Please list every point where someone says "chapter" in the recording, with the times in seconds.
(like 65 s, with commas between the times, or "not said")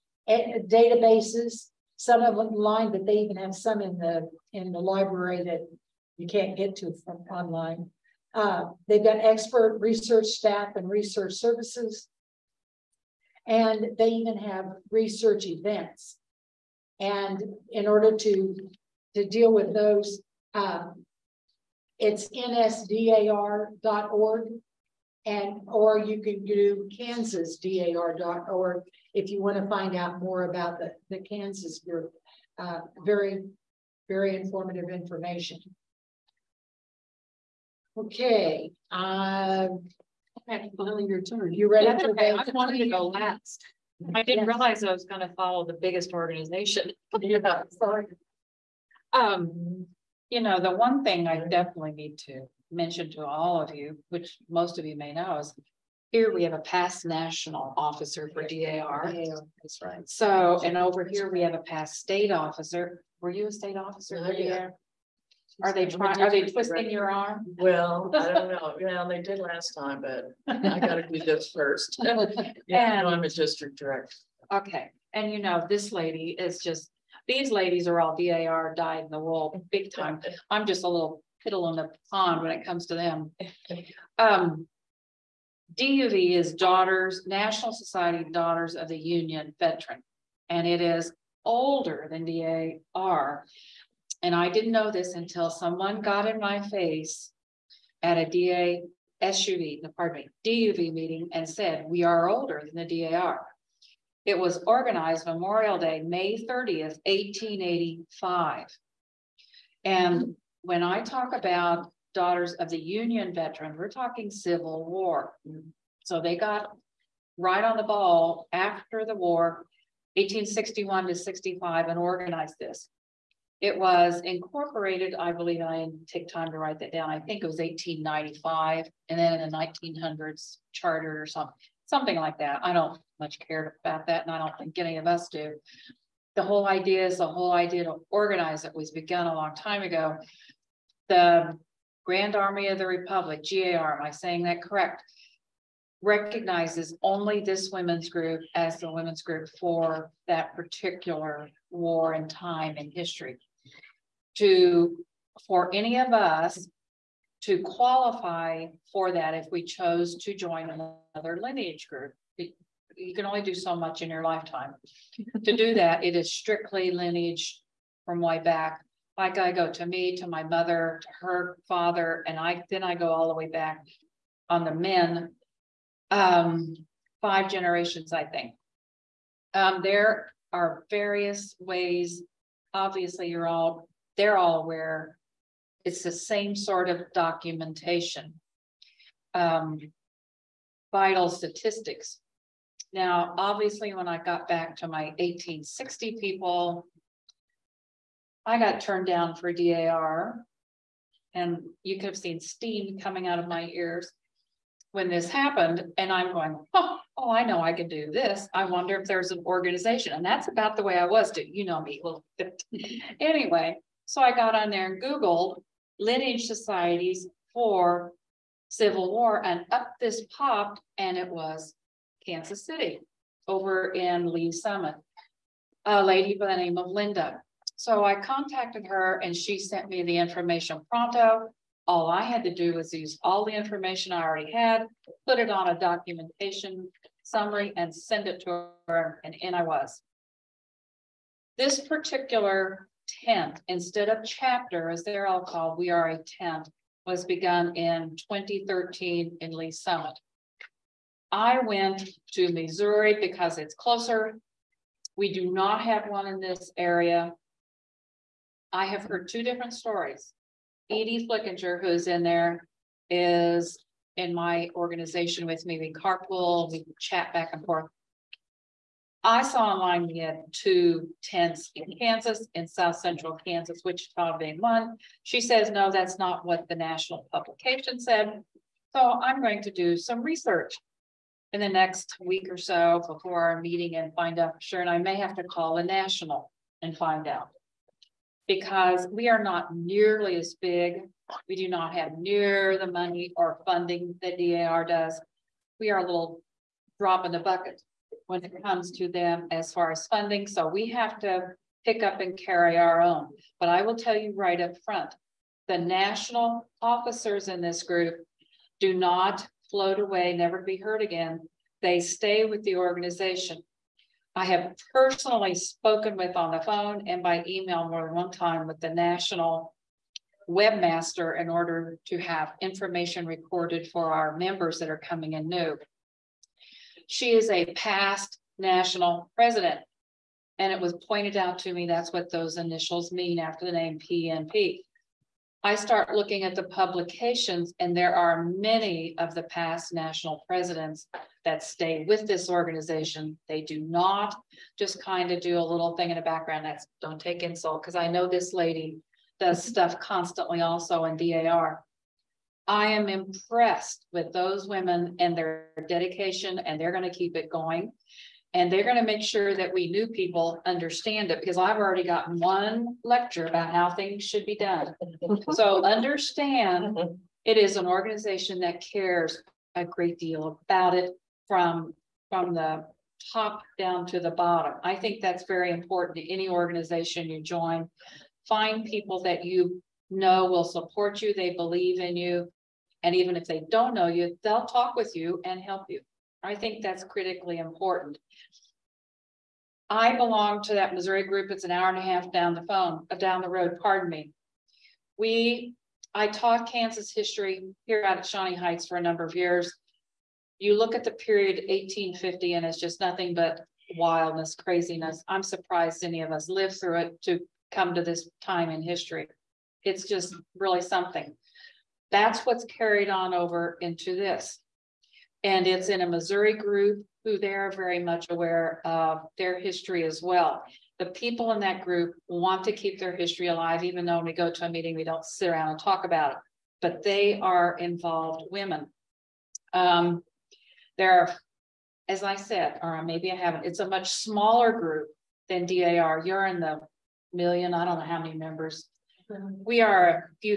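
244 s.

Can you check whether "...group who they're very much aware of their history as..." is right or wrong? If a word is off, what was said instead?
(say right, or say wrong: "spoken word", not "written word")
right.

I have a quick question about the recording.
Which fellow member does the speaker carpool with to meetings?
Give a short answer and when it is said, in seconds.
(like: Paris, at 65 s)
Edie Flickinger, at 260 s.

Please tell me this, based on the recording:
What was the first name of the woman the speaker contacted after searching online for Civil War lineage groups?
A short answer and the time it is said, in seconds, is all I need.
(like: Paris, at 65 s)
Linda, at 226 s.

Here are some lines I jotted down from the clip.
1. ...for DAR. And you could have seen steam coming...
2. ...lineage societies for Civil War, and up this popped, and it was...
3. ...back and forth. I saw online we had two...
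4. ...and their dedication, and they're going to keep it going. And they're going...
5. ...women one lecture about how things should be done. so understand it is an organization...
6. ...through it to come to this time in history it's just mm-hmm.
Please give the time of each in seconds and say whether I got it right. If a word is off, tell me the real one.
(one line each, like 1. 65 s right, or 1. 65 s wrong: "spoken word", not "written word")
1. 199 s right
2. 216 s right
3. 267 s right
4. 355 s right
5. 362 s wrong: "gotten", not "women"
6. 406 s right.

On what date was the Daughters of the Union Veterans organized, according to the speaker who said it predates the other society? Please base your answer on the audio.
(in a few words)
May 30th, 1885.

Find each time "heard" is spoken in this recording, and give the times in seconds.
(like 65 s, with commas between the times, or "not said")
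259 s, 310 s.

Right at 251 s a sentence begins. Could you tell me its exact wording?
I went to Missouri because it's closer.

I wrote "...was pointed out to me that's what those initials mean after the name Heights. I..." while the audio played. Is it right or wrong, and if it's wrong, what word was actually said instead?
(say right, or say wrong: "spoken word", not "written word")
wrong: "PNP", not "Heights".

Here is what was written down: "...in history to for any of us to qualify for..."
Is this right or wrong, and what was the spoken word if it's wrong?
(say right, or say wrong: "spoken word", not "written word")
right.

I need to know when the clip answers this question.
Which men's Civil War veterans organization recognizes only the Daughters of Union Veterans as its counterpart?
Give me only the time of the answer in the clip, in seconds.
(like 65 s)
141 s.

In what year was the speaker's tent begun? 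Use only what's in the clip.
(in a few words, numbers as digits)
2013.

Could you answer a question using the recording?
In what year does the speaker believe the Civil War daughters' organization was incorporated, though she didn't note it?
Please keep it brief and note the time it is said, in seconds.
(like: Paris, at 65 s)
1895, at 127 s.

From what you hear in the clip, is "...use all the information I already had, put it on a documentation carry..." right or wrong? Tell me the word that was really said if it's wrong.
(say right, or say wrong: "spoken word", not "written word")
wrong: "summary", not "carry".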